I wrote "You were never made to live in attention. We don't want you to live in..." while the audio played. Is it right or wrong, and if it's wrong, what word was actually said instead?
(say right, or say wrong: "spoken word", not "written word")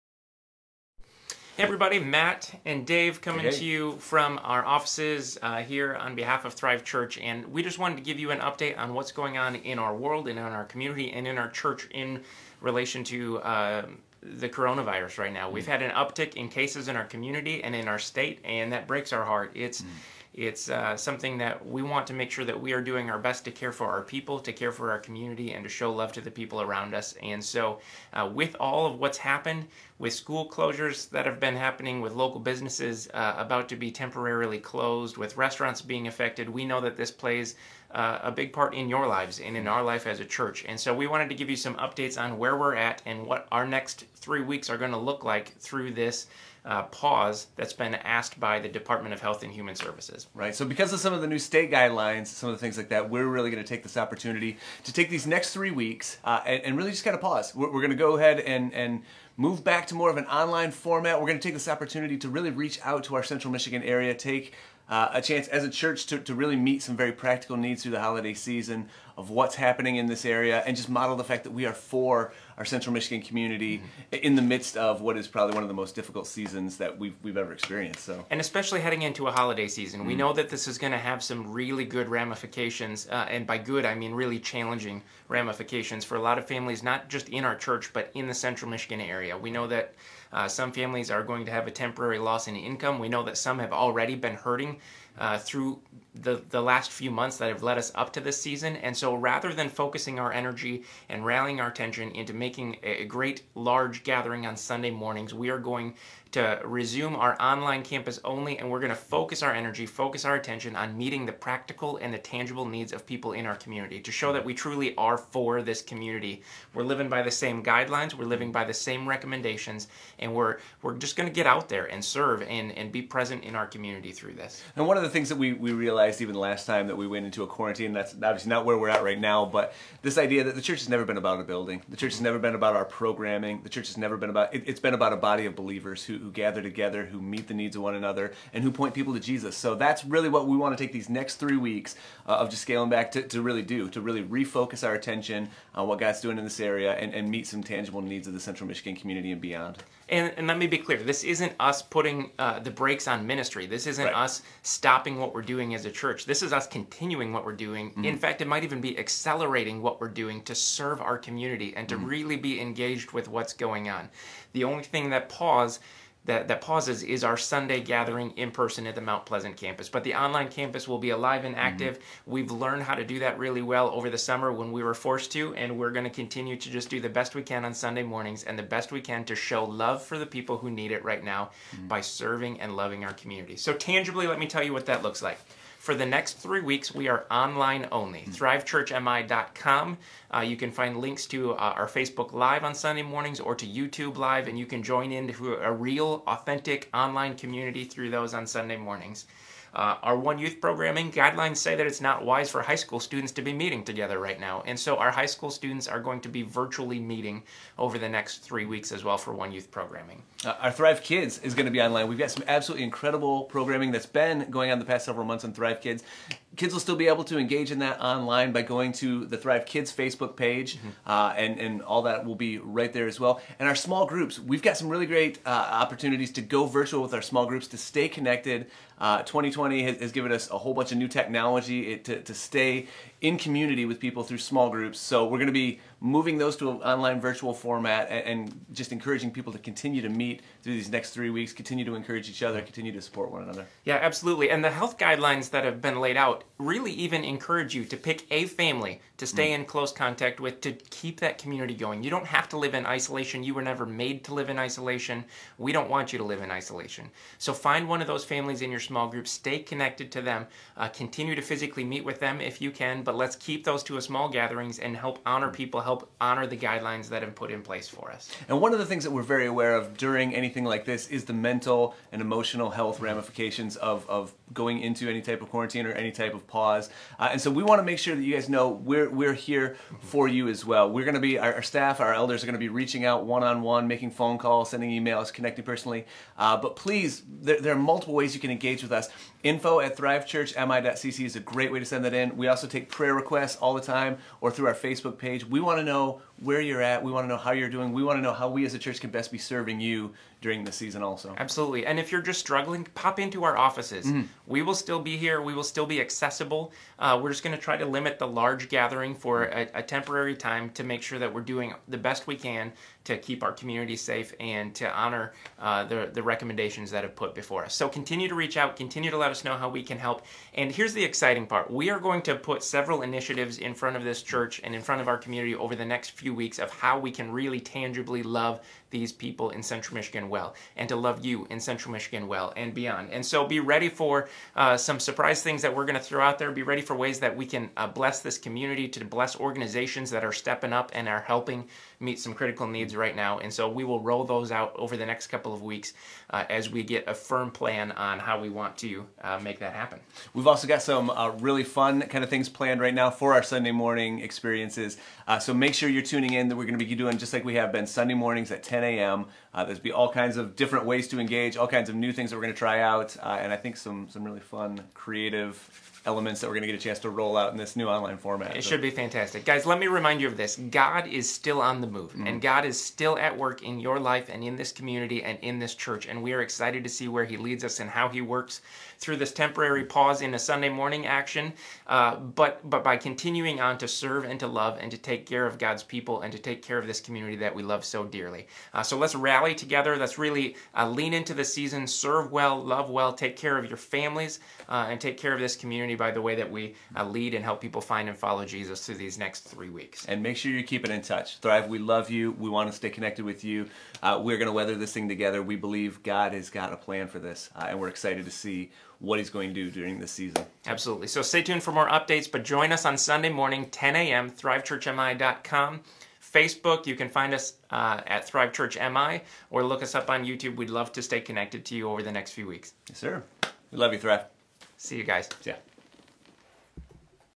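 wrong: "isolation", not "attention".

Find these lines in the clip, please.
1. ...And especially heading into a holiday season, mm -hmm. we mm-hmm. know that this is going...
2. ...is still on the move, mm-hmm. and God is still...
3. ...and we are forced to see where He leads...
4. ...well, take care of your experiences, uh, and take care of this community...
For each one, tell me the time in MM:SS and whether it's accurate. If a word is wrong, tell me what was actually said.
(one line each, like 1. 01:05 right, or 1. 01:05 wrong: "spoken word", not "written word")
1. 01:18 right
2. 06:11 right
3. 06:16 wrong: "excited", not "forced"
4. 06:32 wrong: "families", not "experiences".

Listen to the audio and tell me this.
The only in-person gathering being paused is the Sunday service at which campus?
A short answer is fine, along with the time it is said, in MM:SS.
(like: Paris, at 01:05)
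Mount Pleasant, at 02:49.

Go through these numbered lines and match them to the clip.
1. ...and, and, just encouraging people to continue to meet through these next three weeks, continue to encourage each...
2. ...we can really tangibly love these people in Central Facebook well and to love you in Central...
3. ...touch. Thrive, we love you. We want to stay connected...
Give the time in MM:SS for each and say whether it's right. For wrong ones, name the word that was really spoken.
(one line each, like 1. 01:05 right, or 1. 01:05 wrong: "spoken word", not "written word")
1. 03:58 right
2. 05:26 wrong: "Michigan", not "Facebook"
3. 06:41 right.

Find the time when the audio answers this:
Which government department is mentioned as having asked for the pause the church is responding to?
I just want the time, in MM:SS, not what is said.
00:48.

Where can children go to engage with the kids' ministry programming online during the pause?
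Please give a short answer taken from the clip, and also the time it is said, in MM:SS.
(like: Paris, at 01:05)
Thrive Kids Facebook page, at 03:39.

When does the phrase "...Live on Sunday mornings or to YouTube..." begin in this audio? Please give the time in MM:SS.
03:12.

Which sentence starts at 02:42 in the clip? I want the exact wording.
really be engaged with what's going on.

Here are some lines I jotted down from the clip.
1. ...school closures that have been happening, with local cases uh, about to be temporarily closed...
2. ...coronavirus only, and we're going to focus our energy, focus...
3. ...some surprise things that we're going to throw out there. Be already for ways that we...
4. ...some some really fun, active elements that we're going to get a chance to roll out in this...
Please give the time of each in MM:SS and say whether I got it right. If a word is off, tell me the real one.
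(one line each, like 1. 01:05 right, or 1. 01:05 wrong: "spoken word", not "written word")
1. 00:30 wrong: "businesses", not "cases"
2. 01:47 wrong: "campus", not "coronavirus"
3. 05:34 wrong: "ready", not "already"
4. 06:03 wrong: "creative", not "active".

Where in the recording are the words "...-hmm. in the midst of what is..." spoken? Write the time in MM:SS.
01:14.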